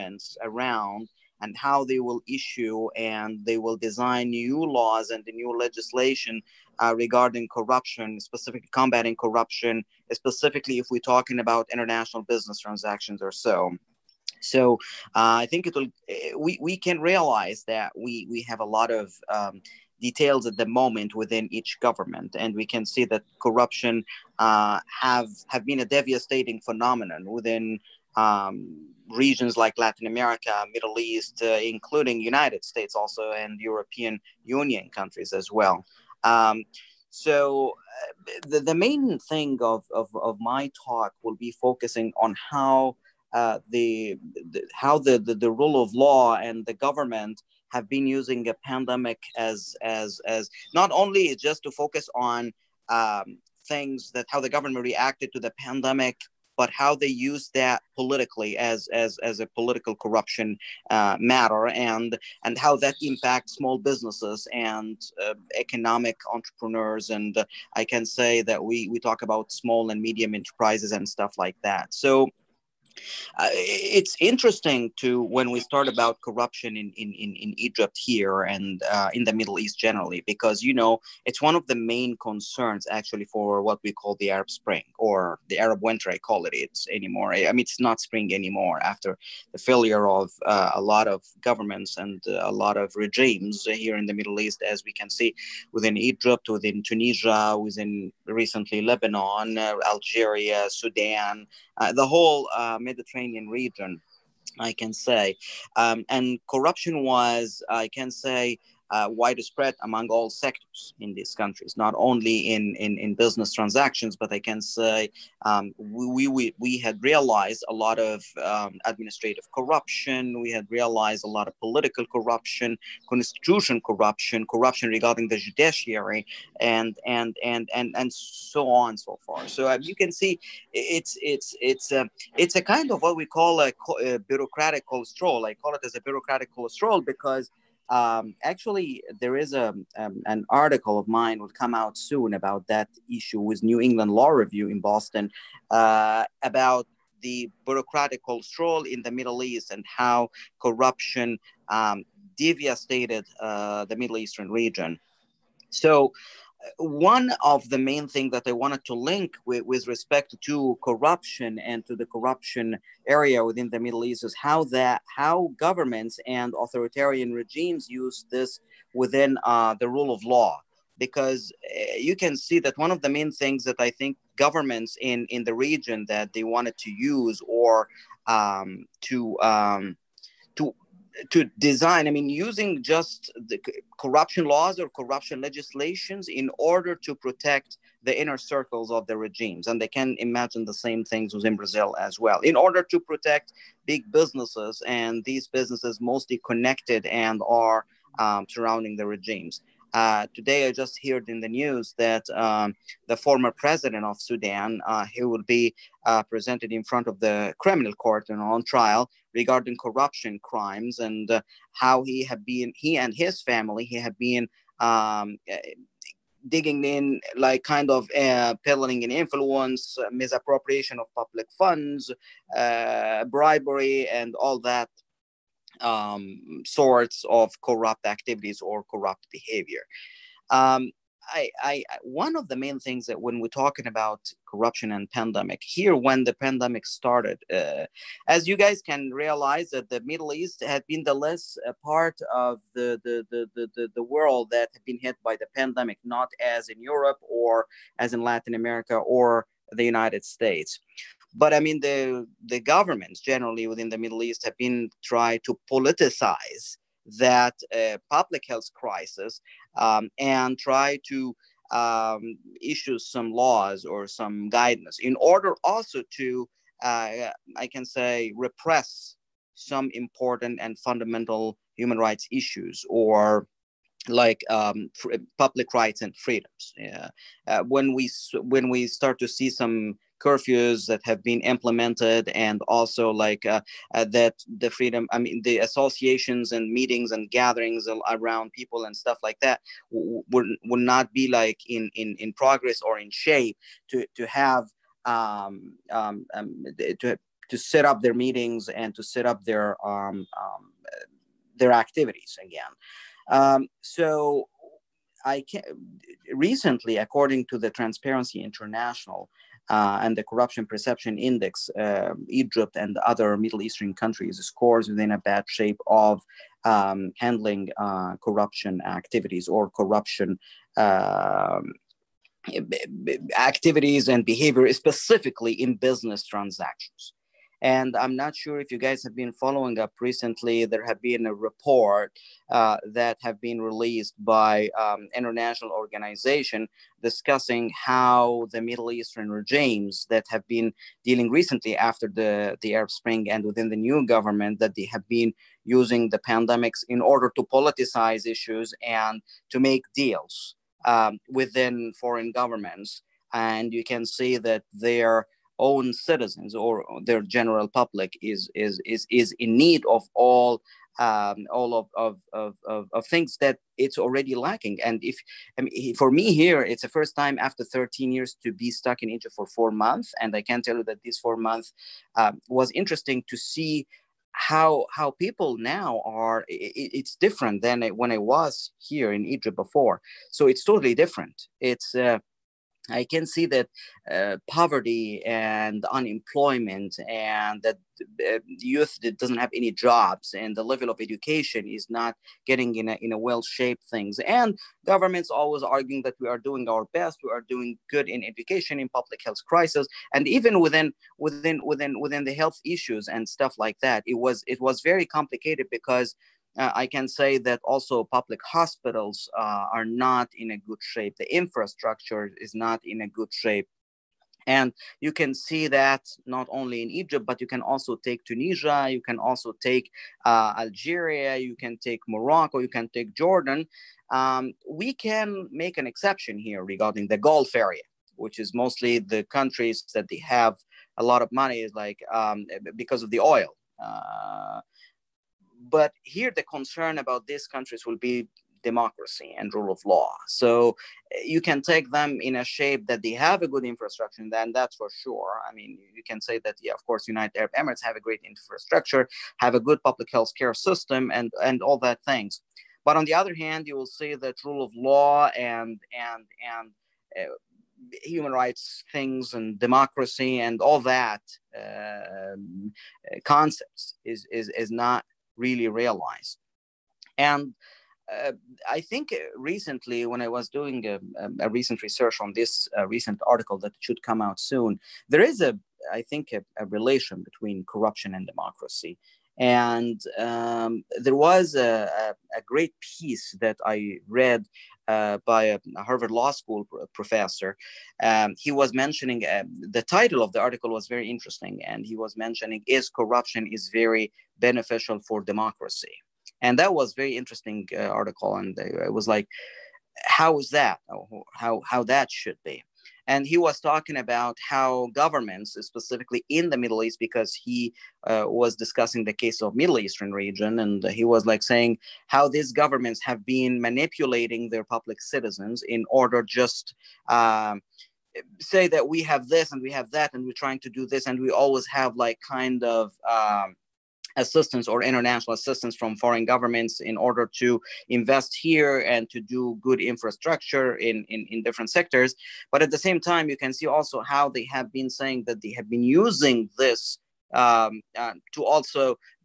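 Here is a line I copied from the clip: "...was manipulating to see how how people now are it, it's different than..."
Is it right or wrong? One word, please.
wrong.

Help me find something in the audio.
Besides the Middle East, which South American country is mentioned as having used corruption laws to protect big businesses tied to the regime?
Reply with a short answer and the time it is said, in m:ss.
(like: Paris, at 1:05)
Brazil, at 3:11.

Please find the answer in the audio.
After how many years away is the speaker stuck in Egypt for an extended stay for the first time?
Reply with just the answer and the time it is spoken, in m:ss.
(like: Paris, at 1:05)
13, at 6:07.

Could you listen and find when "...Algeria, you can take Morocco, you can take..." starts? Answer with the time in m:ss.
7:00.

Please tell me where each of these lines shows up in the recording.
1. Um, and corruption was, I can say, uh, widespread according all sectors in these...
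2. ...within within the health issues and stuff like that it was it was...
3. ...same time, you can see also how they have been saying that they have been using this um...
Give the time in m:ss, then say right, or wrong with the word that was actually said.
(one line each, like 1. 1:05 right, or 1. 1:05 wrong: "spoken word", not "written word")
1. 1:45 wrong: "among", not "according"
2. 6:41 right
3. 8:52 right.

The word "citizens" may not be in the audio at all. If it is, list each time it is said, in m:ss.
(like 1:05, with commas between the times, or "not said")
5:55, 8:35.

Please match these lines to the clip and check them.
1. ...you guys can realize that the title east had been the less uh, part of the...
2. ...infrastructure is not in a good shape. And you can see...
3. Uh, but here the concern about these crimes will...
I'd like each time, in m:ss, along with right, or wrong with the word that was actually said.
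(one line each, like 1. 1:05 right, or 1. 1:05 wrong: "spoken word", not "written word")
1. 3:58 wrong: "middle", not "title"
2. 6:51 right
3. 7:13 wrong: "countries", not "crimes".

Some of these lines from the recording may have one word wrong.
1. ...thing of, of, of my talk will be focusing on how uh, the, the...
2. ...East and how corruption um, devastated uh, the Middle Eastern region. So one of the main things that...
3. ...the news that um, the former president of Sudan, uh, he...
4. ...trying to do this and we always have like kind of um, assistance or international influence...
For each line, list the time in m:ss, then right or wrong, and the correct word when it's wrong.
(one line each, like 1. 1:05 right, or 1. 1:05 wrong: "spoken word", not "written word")
1. 0:39 right
2. 2:29 right
3. 3:21 right
4. 8:40 wrong: "assistance", not "influence".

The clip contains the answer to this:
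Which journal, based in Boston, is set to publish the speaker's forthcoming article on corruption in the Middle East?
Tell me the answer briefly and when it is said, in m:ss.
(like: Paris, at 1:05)
New England Law Review, at 2:23.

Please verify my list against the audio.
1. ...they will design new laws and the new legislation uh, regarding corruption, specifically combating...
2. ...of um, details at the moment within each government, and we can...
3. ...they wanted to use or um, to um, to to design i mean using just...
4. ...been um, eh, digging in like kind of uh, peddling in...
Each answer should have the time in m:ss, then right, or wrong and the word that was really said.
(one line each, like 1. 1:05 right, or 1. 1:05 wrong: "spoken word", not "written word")
1. 0:03 right
2. 0:18 right
3. 2:56 right
4. 3:34 right.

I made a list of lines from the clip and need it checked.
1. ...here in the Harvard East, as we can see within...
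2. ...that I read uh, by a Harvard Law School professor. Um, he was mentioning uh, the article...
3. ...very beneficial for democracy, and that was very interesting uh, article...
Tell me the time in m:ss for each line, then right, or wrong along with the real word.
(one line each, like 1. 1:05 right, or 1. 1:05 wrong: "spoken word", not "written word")
1. 1:33 wrong: "Middle", not "Harvard"
2. 8:03 wrong: "title", not "article"
3. 8:13 right.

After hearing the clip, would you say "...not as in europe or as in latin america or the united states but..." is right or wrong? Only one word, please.
right.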